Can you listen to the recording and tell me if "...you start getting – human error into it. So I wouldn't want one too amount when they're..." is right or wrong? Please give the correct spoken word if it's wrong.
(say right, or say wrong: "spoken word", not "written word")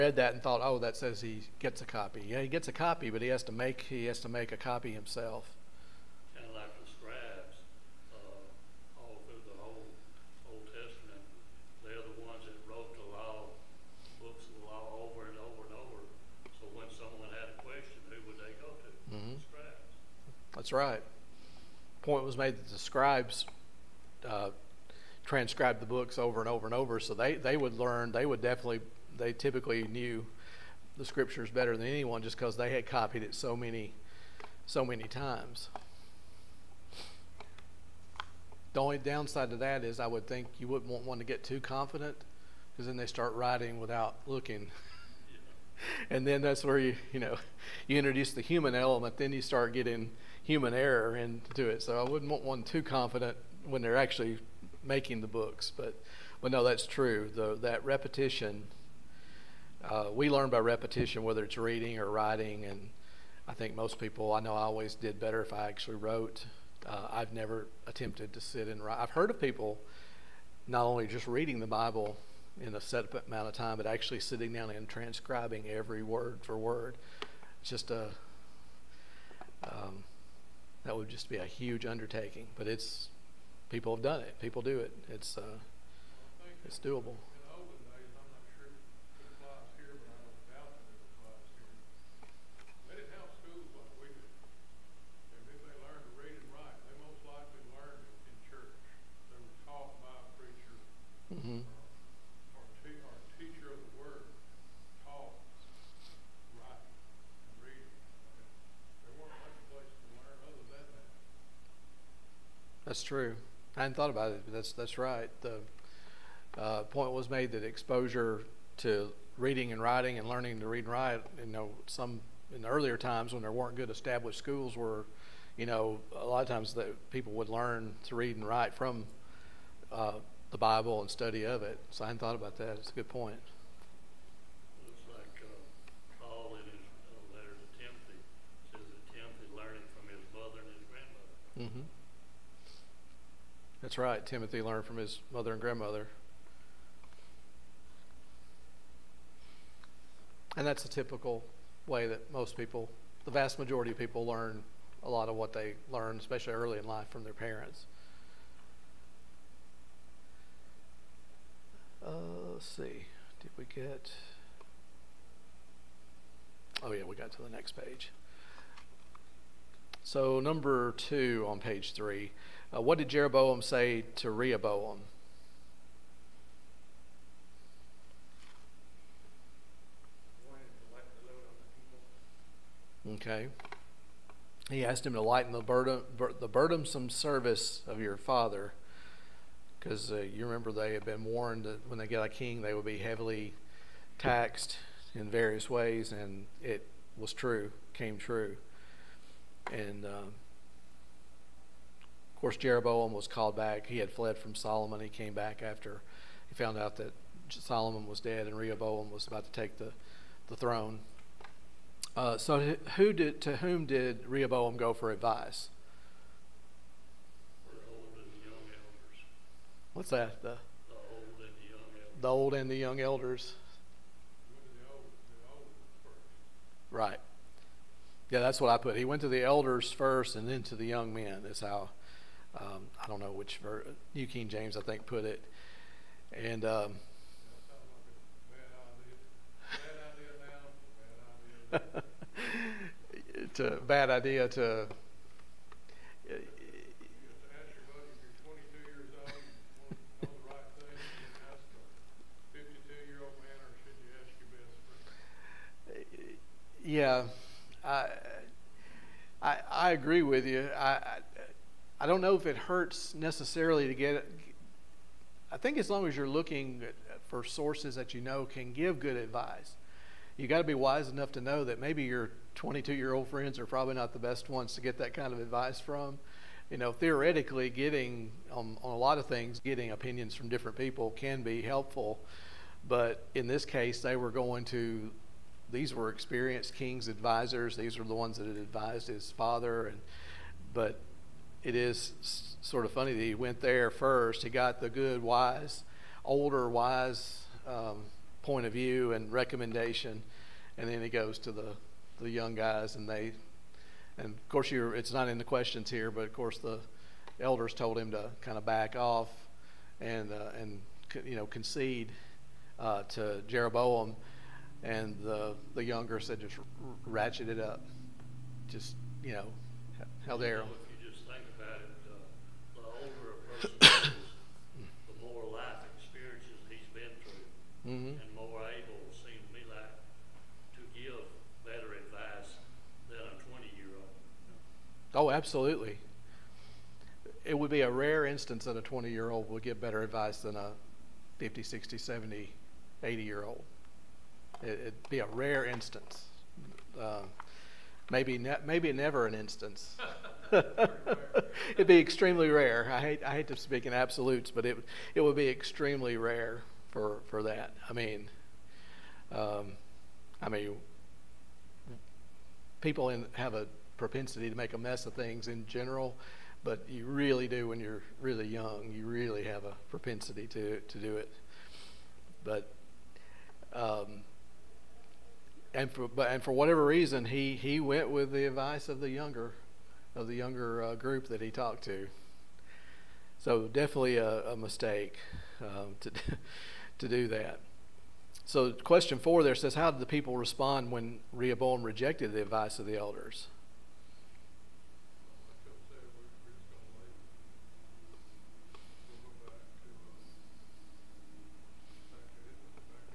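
wrong: "confident", not "amount".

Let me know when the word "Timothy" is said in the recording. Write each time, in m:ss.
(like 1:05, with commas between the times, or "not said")
2:24.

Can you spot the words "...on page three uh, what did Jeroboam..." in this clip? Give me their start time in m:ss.
2:51.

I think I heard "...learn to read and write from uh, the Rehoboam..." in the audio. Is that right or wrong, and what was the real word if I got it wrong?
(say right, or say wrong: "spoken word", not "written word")
wrong: "Bible", not "Rehoboam".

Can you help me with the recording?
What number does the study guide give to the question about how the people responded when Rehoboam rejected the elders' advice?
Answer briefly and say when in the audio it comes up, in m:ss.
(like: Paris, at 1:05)
4, at 6:29.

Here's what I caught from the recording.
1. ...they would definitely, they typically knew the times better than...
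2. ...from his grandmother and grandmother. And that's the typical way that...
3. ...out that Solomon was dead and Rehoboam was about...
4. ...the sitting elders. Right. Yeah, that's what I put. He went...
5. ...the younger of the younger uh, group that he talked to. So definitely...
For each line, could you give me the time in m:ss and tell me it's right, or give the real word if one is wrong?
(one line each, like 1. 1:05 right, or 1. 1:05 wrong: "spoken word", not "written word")
1. 0:28 wrong: "scriptures", not "times"
2. 2:24 wrong: "mother", not "grandmother"
3. 3:26 right
4. 3:42 wrong: "young", not "sitting"
5. 6:18 right.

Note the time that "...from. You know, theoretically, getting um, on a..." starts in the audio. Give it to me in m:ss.
4:35.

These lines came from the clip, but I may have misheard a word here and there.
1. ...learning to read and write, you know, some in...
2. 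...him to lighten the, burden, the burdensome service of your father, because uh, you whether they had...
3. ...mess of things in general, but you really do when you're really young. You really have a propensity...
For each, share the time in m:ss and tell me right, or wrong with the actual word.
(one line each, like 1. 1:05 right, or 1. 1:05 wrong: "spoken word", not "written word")
1. 2:00 right
2. 3:05 wrong: "remember", not "whether"
3. 6:04 right.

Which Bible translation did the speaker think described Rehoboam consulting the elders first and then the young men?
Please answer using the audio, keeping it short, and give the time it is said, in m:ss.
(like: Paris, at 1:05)
New King James, at 3:54.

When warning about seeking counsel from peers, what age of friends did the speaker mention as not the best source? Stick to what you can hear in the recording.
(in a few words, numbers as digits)
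22.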